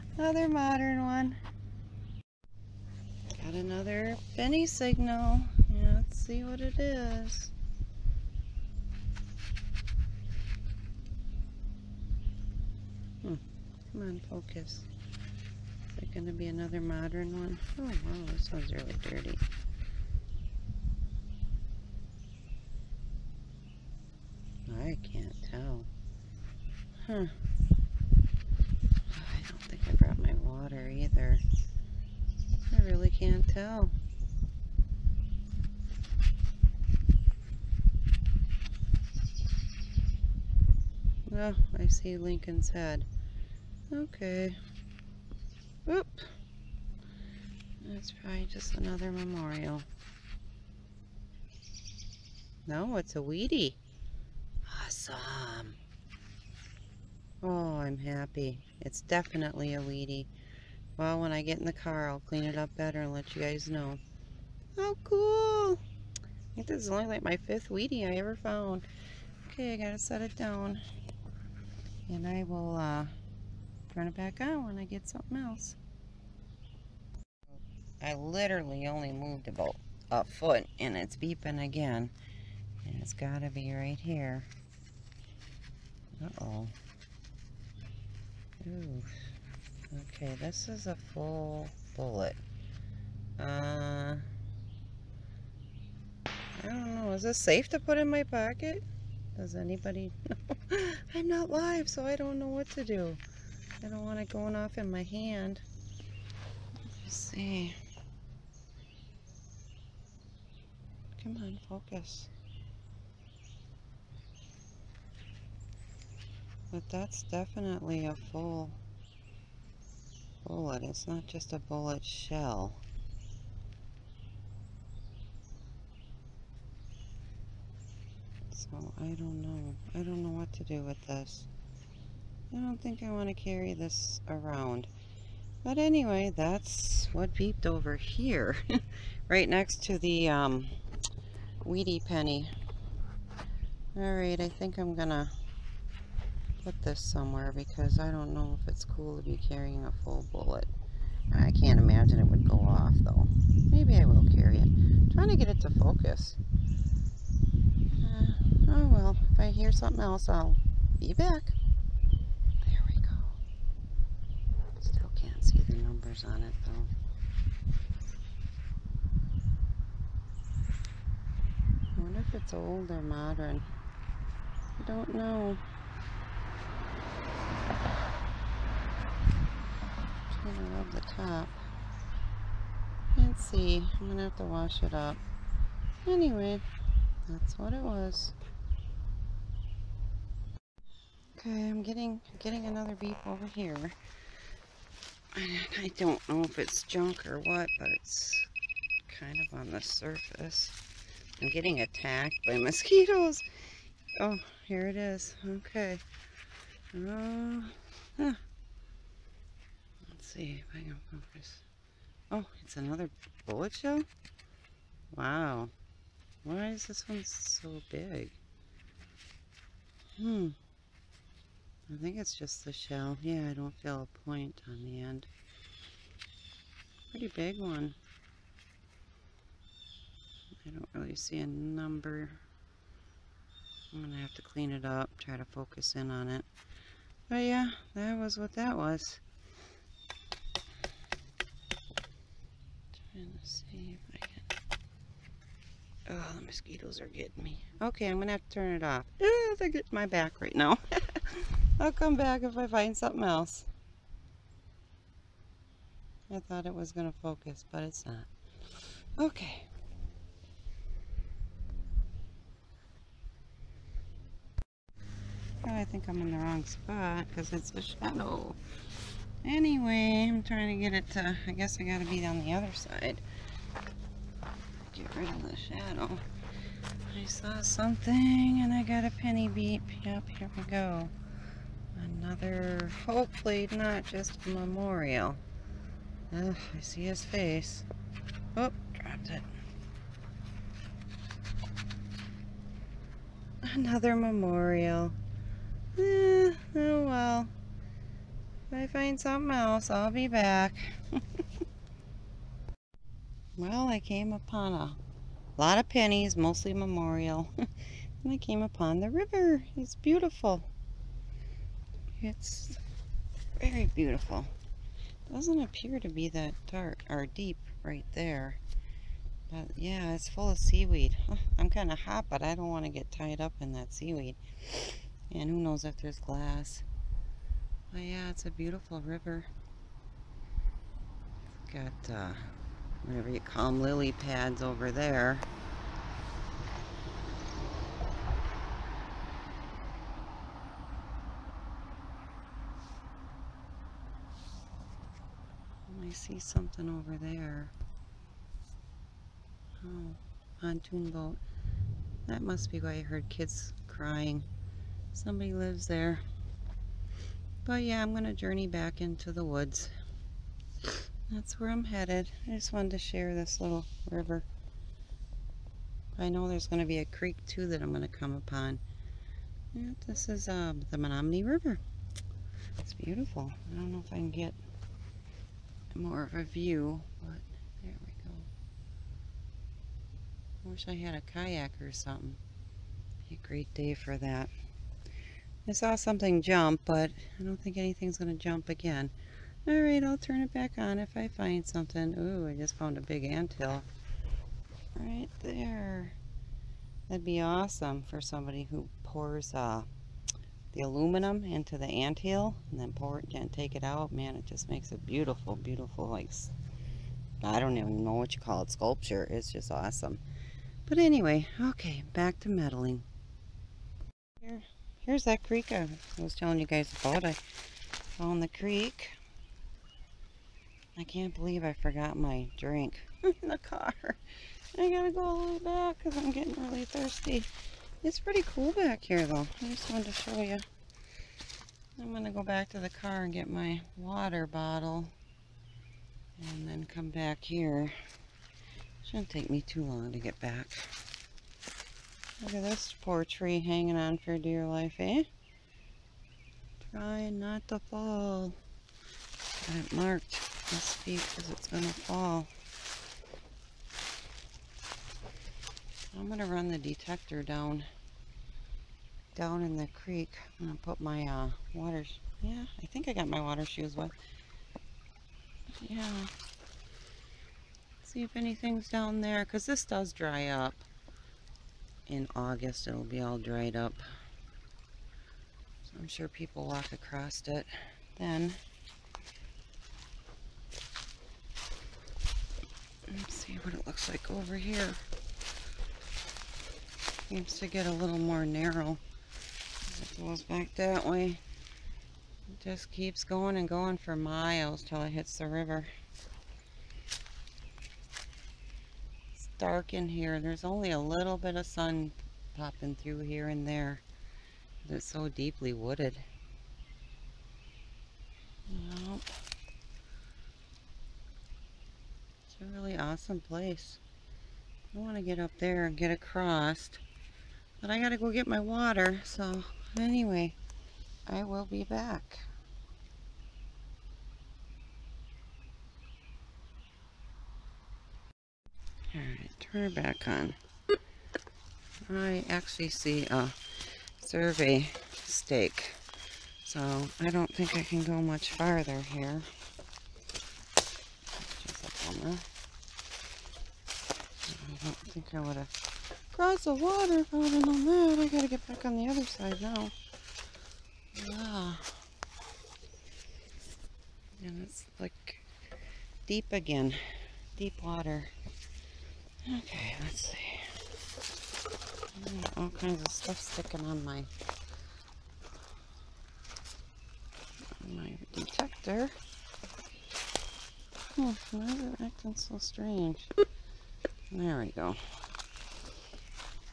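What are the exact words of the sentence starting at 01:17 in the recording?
I literally only moved about a foot and it's beeping again.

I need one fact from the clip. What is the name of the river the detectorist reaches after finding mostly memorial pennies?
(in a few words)
Menominee River.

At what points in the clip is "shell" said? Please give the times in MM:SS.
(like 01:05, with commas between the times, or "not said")
02:02, 03:33, 03:42.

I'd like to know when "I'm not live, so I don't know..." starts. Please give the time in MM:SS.
01:41.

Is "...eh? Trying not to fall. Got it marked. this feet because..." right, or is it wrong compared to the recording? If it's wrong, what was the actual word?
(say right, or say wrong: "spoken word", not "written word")
right.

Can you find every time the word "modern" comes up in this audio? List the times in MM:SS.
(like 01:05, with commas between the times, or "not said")
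00:00, 00:16, 02:53.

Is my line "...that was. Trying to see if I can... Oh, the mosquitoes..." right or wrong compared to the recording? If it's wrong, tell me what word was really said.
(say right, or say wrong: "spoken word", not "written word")
right.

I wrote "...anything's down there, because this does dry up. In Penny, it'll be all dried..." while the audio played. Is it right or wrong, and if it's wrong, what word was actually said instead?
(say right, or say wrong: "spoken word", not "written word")
wrong: "August", not "Penny".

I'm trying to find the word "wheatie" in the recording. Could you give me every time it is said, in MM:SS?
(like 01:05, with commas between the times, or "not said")
00:53, 00:59, 01:07, 02:21.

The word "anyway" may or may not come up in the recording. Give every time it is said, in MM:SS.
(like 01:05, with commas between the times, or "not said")
02:15, 03:06, 04:29, 06:50, 08:39.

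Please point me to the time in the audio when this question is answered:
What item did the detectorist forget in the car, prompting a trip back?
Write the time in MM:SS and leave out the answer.
07:13.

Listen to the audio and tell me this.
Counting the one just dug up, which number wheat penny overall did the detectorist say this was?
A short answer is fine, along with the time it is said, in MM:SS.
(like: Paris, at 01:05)
5th, at 01:07.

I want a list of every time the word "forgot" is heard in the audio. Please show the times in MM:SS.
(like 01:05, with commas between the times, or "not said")
07:01.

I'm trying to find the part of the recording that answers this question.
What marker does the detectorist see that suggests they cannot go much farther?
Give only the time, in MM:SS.
08:54.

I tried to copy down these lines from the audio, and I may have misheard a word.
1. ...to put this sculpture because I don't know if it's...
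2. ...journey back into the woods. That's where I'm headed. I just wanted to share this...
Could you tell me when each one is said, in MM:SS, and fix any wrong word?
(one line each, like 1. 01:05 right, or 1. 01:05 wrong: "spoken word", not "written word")
1. 02:25 wrong: "somewhere", not "sculpture"
2. 05:58 right.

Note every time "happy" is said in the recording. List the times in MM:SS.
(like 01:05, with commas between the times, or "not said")
00:57.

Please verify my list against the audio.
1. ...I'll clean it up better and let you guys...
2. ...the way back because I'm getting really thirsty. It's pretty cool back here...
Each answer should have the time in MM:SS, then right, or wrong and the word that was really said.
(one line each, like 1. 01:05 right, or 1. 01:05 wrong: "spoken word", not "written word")
1. 01:02 right
2. 07:05 right.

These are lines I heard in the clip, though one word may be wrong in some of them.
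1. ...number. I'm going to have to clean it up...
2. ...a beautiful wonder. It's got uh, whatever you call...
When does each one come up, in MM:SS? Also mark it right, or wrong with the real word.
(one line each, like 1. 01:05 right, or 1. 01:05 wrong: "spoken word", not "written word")
1. 03:51 right
2. 05:28 wrong: "river", not "wonder".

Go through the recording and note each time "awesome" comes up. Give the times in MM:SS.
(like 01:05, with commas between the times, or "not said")
00:54, 06:37, 06:49, 08:32.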